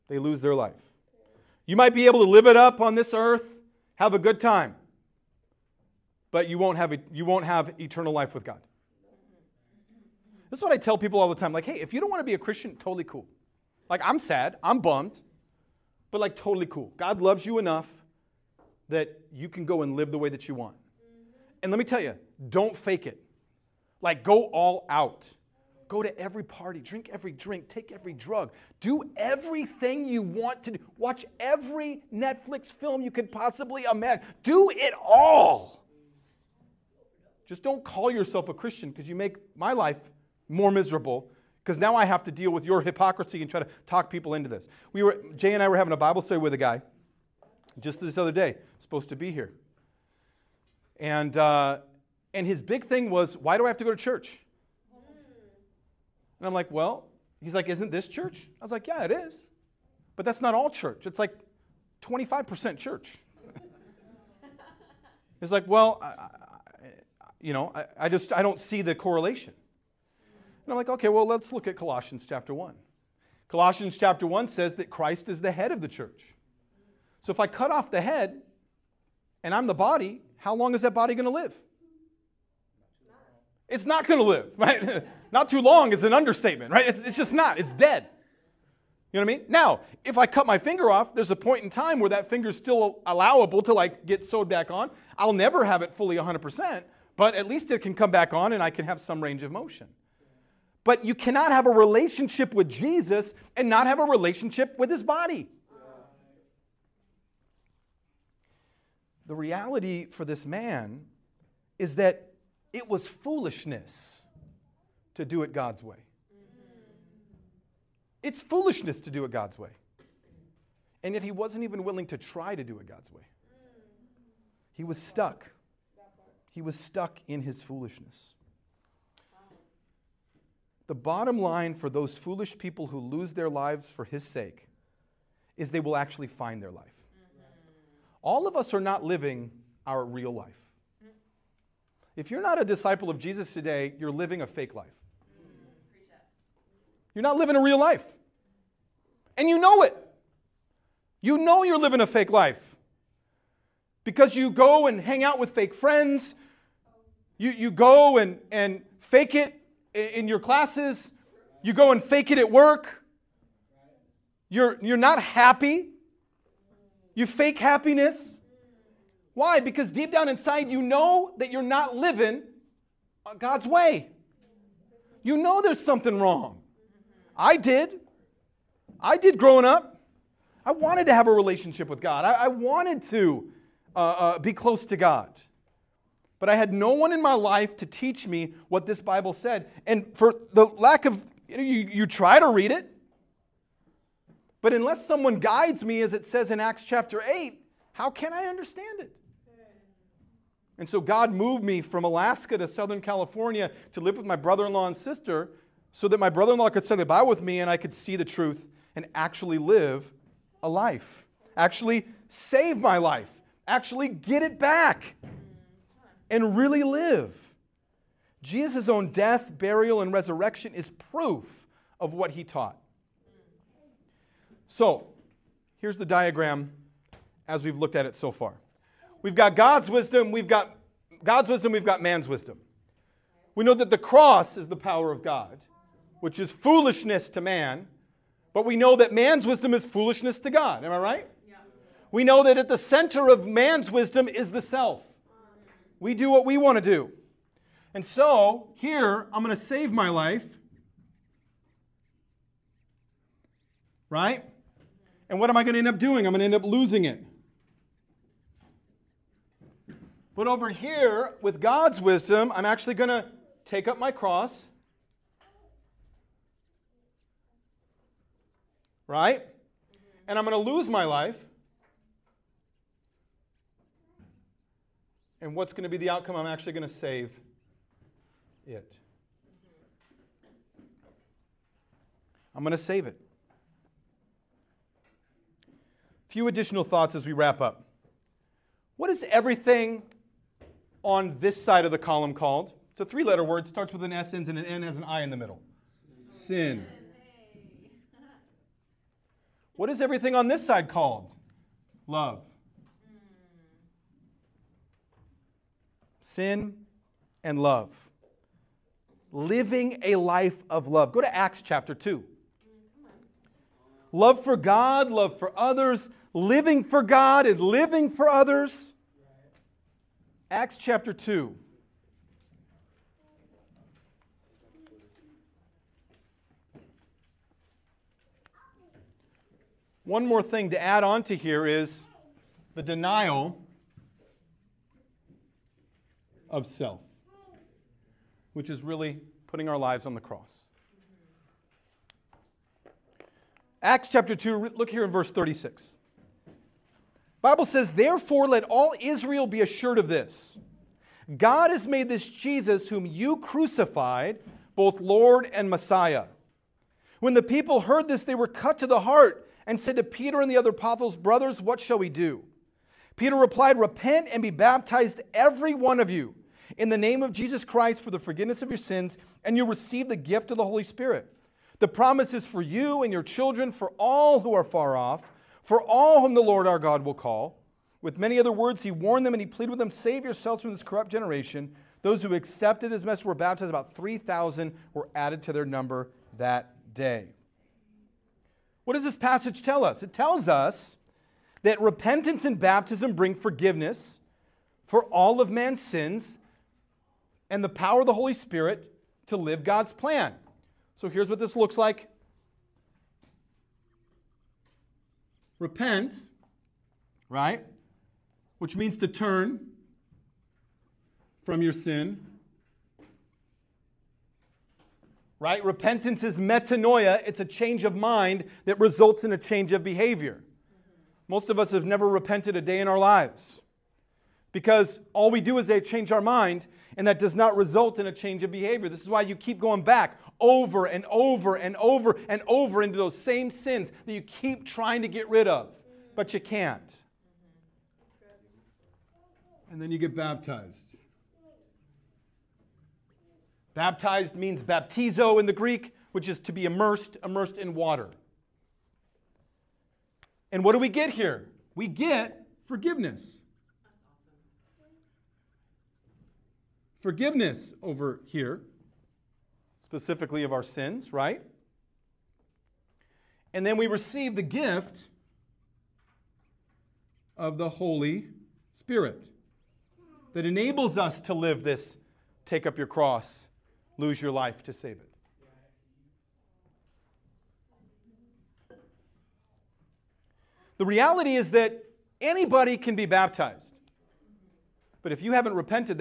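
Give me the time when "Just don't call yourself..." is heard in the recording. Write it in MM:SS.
00:37.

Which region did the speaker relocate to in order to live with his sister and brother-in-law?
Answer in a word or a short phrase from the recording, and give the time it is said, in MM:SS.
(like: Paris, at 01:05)
Southern California, at 03:22.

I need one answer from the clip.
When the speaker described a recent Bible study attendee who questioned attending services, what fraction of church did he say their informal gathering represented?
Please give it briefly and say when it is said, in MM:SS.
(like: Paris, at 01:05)
25%, at 01:02.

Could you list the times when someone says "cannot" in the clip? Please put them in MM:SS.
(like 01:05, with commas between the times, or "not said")
01:41.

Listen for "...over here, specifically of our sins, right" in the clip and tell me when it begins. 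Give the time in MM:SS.
07:37.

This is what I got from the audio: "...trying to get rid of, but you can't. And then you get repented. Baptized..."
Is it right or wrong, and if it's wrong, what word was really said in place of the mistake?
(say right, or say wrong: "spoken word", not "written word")
wrong: "baptized", not "repented".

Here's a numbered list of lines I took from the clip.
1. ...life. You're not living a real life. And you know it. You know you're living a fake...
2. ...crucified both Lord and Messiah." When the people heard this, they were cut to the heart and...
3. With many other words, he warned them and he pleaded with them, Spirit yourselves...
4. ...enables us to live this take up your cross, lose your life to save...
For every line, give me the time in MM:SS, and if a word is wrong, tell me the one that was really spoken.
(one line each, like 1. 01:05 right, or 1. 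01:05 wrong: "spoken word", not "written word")
1. 02:24 right
2. 05:53 right
3. 06:18 wrong: "Save", not "Spirit"
4. 07:50 right.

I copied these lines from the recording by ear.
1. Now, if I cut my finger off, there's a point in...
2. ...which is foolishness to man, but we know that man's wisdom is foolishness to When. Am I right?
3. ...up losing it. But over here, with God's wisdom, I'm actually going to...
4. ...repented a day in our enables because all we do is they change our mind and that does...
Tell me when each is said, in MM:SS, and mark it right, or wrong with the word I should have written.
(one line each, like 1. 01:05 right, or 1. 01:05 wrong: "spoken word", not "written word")
1. 01:29 right
2. 03:56 wrong: "God", not "When"
3. 04:16 right
4. 07:02 wrong: "lives", not "enables".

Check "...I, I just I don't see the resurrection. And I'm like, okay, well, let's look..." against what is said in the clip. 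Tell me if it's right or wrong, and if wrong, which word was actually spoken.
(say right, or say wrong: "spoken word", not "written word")
wrong: "correlation", not "resurrection".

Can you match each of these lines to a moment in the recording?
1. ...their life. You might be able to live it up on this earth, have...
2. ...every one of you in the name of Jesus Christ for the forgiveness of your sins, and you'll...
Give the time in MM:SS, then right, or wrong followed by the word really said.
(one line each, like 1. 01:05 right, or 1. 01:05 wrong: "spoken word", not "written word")
1. 00:00 right
2. 06:05 right.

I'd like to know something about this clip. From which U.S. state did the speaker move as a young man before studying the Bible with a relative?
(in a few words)
Alaska.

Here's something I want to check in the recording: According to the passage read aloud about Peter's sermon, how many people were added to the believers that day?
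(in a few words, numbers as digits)
3,000.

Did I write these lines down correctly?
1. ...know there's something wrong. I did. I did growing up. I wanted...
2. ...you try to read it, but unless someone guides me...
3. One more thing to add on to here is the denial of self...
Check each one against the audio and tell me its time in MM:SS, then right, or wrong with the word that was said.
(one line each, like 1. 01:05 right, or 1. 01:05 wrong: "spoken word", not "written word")
1. 02:55 right
2. 03:11 right
3. 05:30 right.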